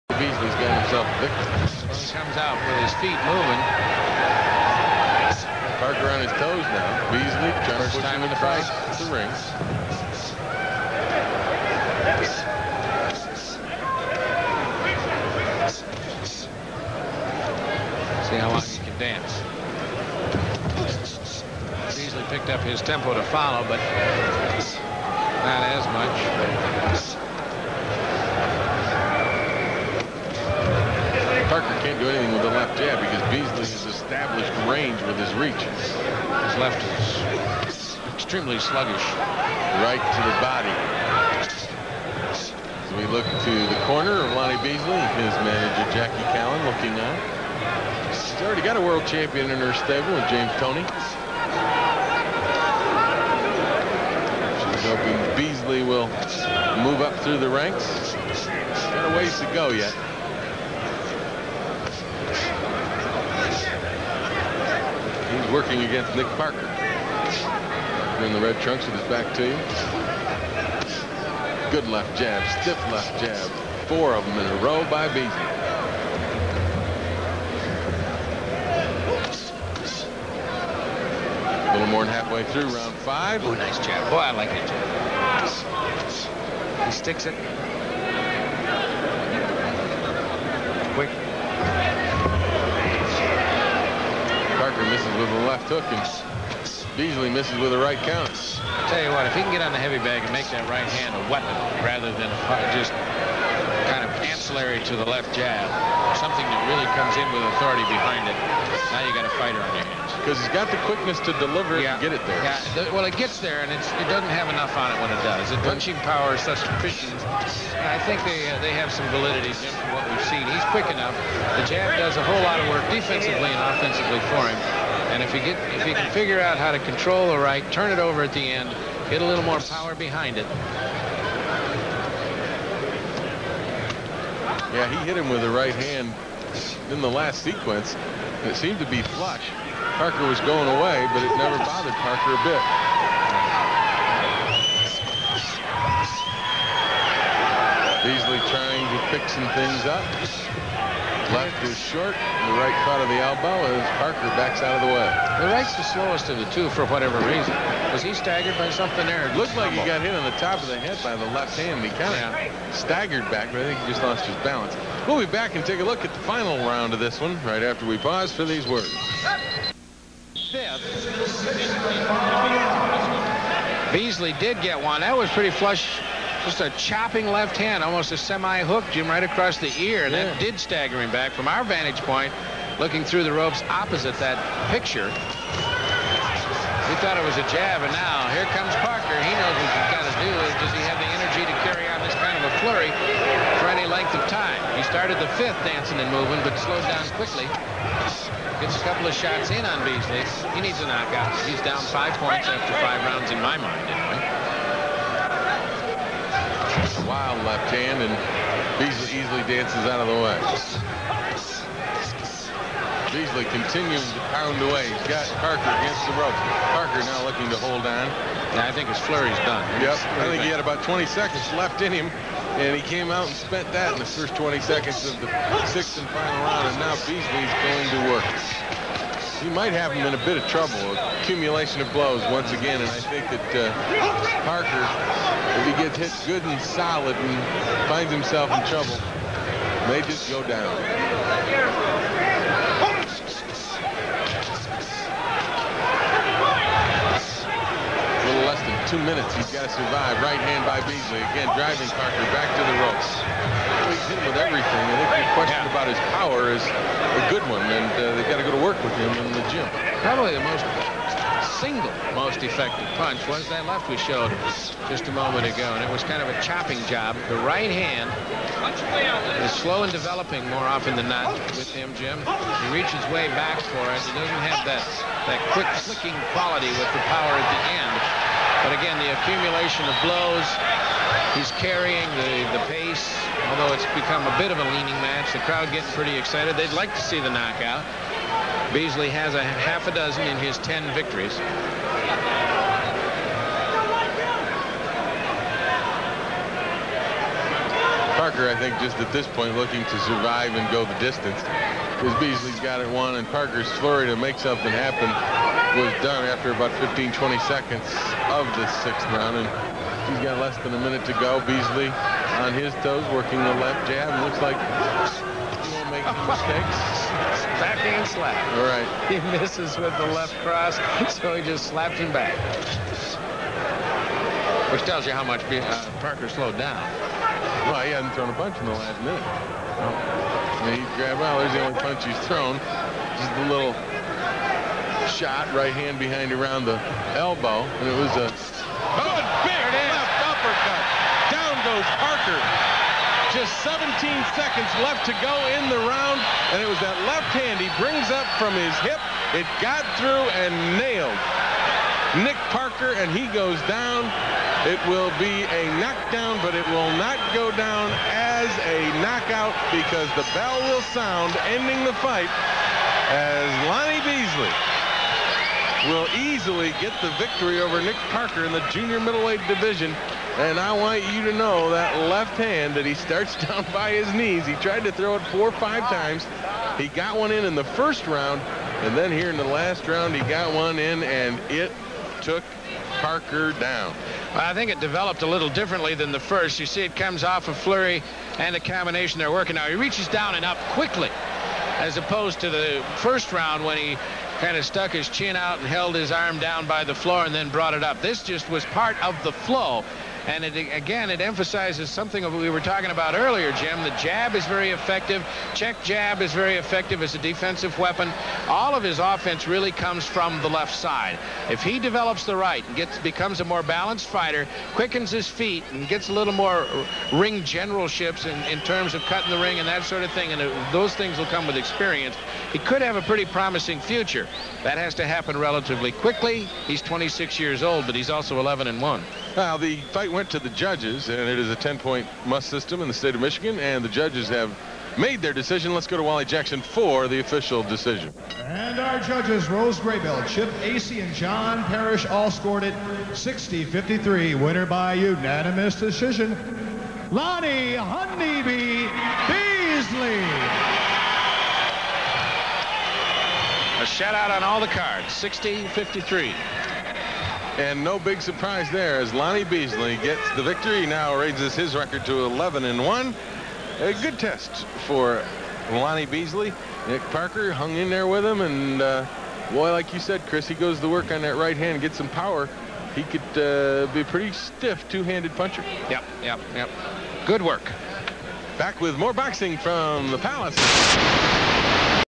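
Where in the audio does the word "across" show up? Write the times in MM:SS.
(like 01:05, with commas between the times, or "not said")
02:59.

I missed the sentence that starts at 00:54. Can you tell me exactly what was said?
She's hoping Beasley will move up through the ranks.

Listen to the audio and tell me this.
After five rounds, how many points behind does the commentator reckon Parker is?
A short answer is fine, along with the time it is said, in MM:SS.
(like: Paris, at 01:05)
5, at 03:21.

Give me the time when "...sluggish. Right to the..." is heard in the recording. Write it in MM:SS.
00:38.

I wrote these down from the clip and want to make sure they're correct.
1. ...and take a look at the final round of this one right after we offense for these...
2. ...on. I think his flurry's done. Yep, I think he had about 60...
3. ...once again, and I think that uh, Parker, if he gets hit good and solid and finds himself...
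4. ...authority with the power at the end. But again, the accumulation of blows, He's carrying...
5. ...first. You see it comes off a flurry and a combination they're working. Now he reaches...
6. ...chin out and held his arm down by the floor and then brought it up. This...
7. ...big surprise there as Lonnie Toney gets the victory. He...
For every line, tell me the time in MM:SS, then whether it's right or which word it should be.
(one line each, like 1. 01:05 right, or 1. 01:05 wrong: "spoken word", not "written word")
1. 02:45 wrong: "pause", not "offense"
2. 03:37 wrong: "20", not "60"
3. 03:52 right
4. 04:36 wrong: "quality", not "authority"
5. 06:26 right
6. 06:35 right
7. 07:37 wrong: "Beasley", not "Toney".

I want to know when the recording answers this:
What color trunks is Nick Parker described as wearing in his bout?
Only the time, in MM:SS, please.
01:08.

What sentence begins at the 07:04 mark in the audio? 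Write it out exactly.
That has to happen relatively quickly.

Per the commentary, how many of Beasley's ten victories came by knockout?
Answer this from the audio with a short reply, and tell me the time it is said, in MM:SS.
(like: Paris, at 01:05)
Half a dozen, at 04:49.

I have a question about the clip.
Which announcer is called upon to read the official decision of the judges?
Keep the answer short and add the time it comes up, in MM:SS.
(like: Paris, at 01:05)
Wally Jackson, at 07:16.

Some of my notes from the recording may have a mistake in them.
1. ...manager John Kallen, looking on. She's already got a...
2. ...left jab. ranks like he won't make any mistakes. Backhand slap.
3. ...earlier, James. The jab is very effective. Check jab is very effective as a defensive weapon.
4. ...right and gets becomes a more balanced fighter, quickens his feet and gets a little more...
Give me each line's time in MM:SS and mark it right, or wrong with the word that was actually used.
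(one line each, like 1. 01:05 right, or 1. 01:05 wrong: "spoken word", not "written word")
1. 00:45 wrong: "Jackie", not "John"
2. 05:13 wrong: "looks", not "ranks"
3. 06:43 wrong: "Jim", not "James"
4. 06:52 right.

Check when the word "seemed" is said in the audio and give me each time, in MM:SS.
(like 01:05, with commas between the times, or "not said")
02:18.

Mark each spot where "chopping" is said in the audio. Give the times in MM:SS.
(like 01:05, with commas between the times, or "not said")
02:56, 04:26.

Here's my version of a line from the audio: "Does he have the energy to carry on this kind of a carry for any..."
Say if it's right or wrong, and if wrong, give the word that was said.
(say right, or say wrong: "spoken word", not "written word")
wrong: "flurry", not "carry".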